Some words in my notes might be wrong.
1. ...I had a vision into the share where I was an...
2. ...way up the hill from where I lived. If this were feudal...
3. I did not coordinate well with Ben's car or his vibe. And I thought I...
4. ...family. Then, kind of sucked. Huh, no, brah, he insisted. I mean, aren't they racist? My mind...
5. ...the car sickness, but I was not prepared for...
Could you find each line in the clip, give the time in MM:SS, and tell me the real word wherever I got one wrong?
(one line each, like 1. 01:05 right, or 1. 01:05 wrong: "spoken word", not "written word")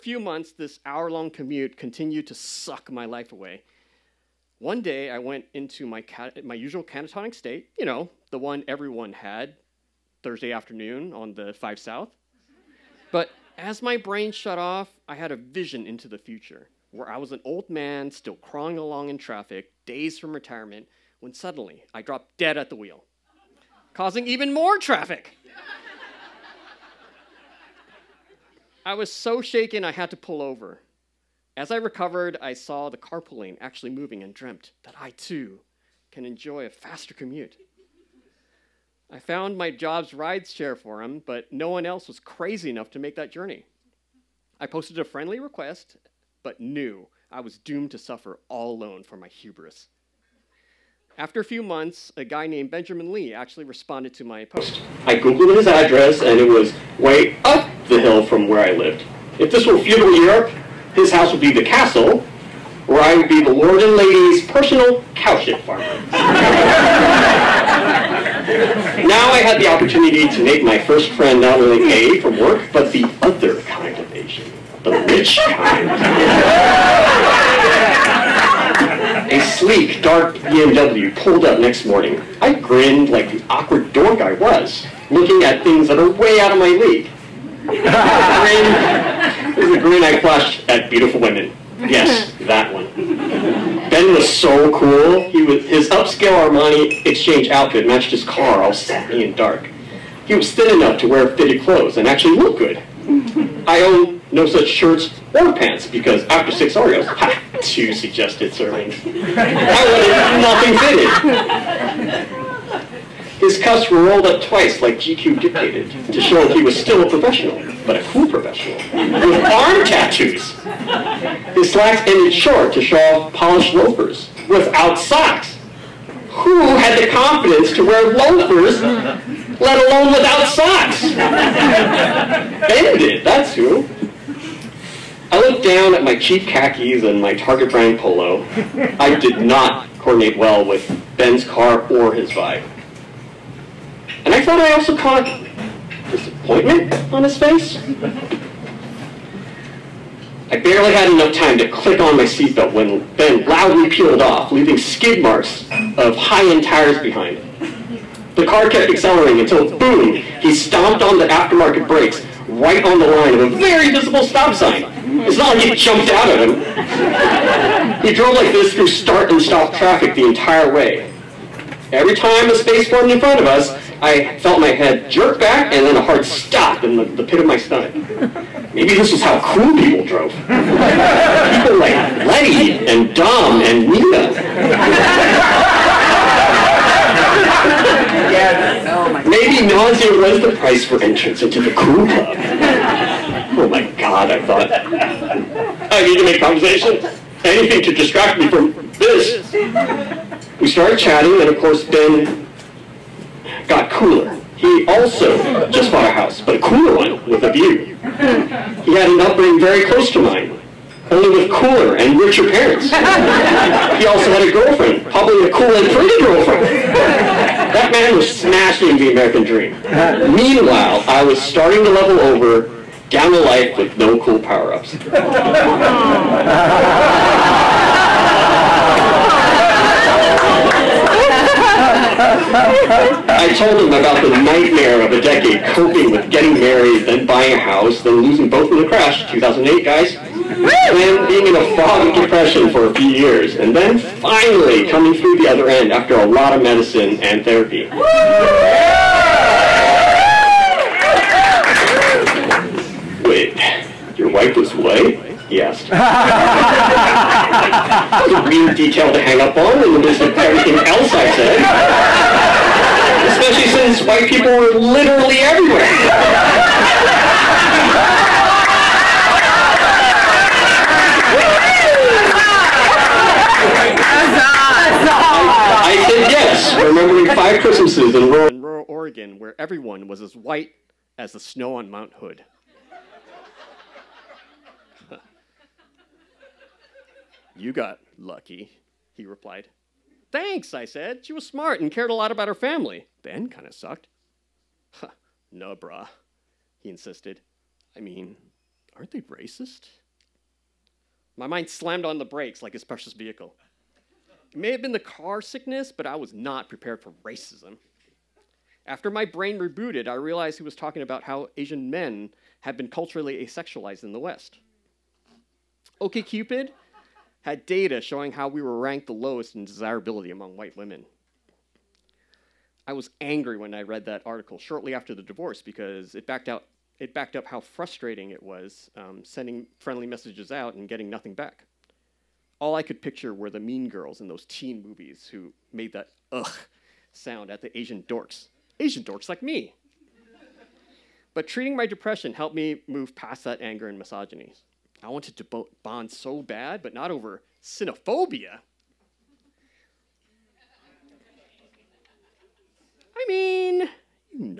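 1. 00:15 wrong: "future", not "share"
2. 00:56 right
3. 02:19 right
4. 04:52 right
5. 05:04 right.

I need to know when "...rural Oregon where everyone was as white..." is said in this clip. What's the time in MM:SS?
04:38.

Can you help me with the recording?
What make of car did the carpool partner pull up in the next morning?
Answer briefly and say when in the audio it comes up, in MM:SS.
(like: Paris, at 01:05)
BMW, at 01:20.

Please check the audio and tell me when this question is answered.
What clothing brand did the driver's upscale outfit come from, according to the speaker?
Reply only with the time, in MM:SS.
01:36.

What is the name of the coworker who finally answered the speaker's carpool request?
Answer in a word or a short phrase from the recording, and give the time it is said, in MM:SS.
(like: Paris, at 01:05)
Benjamin Lee, at 00:52.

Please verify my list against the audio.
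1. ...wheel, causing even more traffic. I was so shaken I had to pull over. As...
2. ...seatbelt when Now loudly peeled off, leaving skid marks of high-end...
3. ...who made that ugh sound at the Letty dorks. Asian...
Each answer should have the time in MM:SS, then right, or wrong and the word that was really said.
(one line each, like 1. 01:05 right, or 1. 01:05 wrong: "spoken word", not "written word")
1. 00:22 right
2. 02:32 wrong: "Ben", not "Now"
3. 05:35 wrong: "Asian", not "Letty".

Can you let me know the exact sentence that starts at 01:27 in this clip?
The is the grin I flashed at beautiful women.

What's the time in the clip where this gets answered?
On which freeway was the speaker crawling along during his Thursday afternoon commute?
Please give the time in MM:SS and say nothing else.
00:11.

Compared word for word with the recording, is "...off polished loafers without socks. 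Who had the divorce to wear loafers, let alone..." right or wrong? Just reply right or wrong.
wrong.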